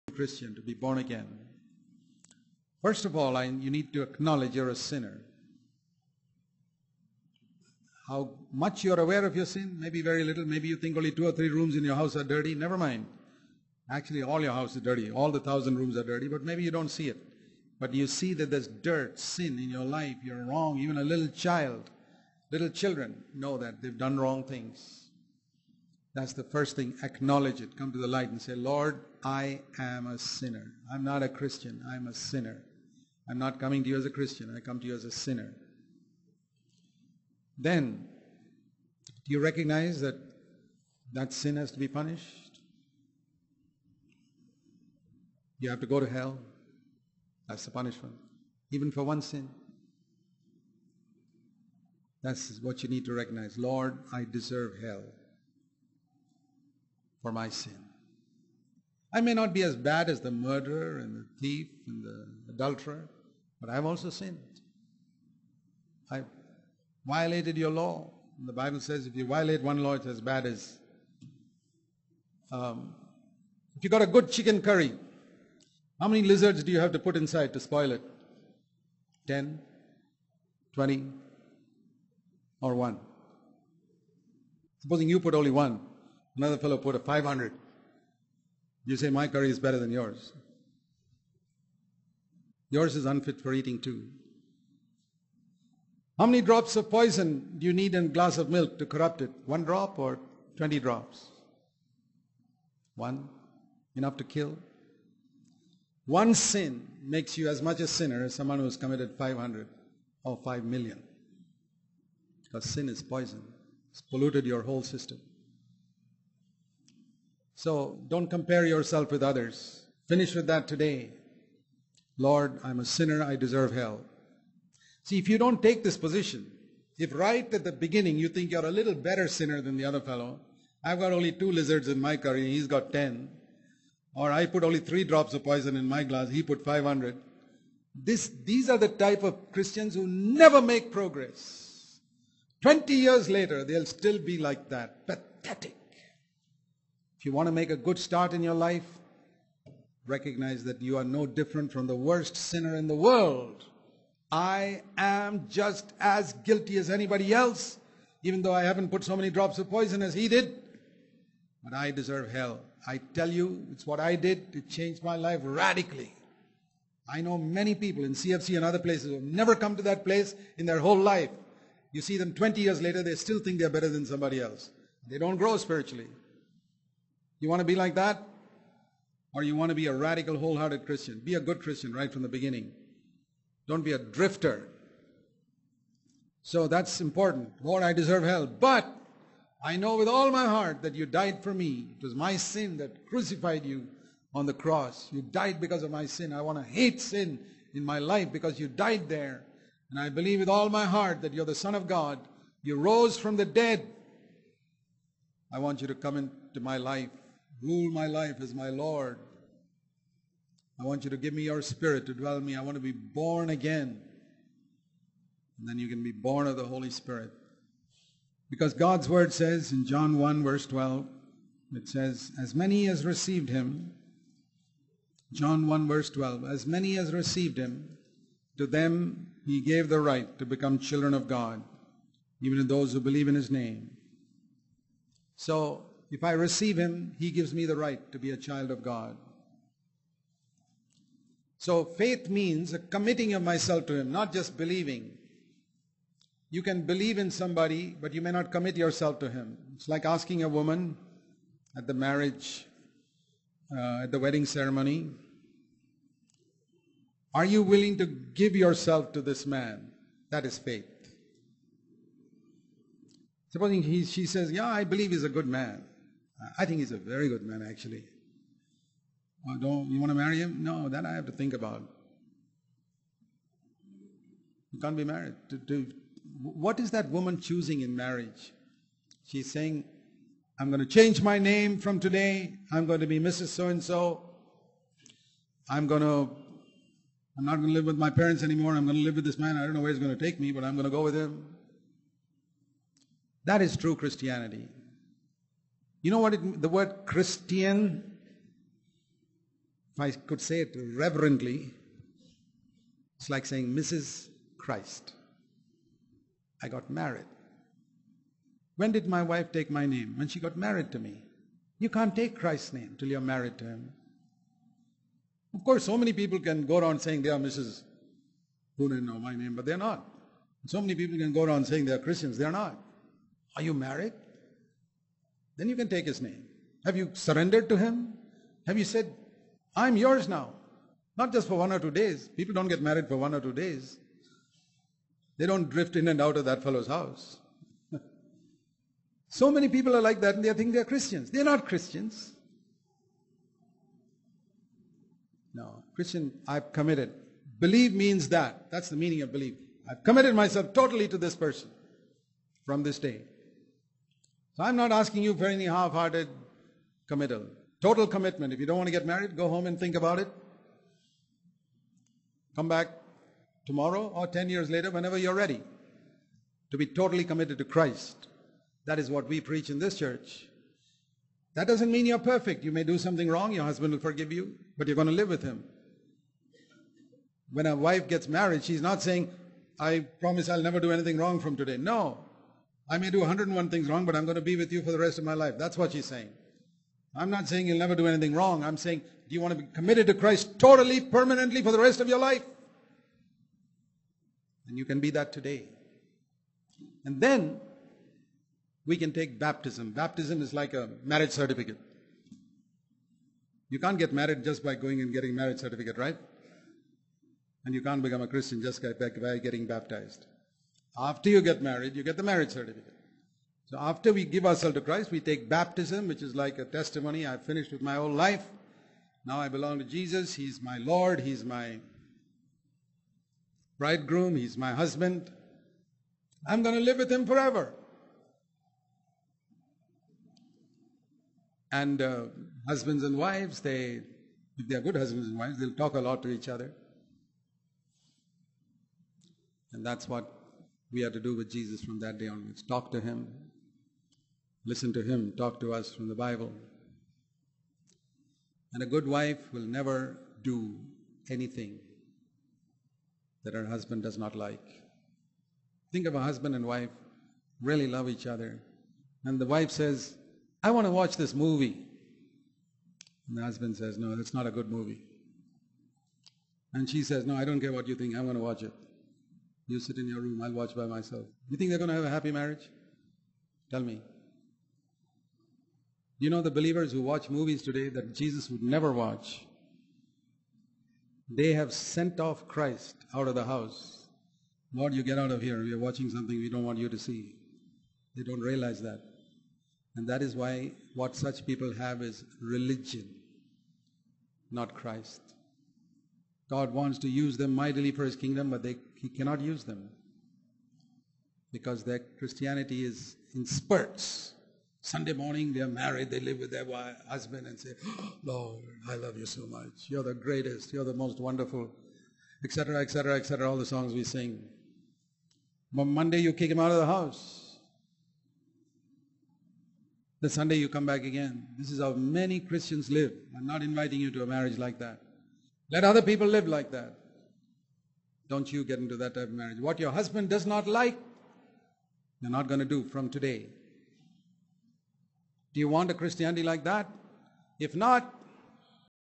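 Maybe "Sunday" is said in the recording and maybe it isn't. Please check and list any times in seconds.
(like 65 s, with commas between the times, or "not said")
504 s, 520 s.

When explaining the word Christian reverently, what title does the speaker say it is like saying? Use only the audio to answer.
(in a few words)
Mrs. Christ.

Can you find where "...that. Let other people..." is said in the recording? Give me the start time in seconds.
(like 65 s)
524 s.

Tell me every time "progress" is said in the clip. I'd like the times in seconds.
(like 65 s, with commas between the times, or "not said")
140 s.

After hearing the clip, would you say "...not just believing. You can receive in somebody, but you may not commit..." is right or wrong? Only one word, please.
wrong.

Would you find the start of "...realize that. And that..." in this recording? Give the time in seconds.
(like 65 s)
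488 s.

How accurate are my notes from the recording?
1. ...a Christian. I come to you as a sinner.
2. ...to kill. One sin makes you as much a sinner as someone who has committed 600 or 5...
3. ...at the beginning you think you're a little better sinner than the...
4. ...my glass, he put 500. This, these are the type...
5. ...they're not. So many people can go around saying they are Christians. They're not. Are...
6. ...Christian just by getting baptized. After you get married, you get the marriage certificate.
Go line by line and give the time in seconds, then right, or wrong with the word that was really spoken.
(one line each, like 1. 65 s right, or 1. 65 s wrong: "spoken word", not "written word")
1. 34 s right
2. 104 s wrong: "500", not "600"
3. 127 s right
4. 135 s right
5. 319 s right
6. 408 s right.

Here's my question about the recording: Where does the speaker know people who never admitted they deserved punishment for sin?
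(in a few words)
CFC.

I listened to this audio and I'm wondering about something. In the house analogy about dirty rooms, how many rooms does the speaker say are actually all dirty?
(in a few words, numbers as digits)
1000.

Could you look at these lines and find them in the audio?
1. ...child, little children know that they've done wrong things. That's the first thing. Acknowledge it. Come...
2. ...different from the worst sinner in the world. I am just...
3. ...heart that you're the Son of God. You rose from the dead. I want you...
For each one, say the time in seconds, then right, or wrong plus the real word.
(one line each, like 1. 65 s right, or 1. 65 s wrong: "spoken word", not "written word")
1. 21 s right
2. 151 s right
3. 200 s right.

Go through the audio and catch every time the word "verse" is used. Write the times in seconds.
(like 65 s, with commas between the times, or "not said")
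220 s, 225 s.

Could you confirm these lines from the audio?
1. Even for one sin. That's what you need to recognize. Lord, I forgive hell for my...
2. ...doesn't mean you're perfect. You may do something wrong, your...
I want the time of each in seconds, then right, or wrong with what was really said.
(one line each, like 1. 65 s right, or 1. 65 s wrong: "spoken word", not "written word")
1. 48 s wrong: "deserve", not "forgive"
2. 371 s right.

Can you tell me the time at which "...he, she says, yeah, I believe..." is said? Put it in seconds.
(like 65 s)
263 s.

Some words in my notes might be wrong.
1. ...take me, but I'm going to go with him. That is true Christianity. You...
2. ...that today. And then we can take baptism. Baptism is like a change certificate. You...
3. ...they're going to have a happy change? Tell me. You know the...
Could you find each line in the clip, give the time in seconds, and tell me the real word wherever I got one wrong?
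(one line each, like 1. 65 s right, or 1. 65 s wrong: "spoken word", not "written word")
1. 290 s right
2. 395 s wrong: "marriage", not "change"
3. 471 s wrong: "marriage", not "change".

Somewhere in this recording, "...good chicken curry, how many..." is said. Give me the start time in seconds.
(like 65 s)
74 s.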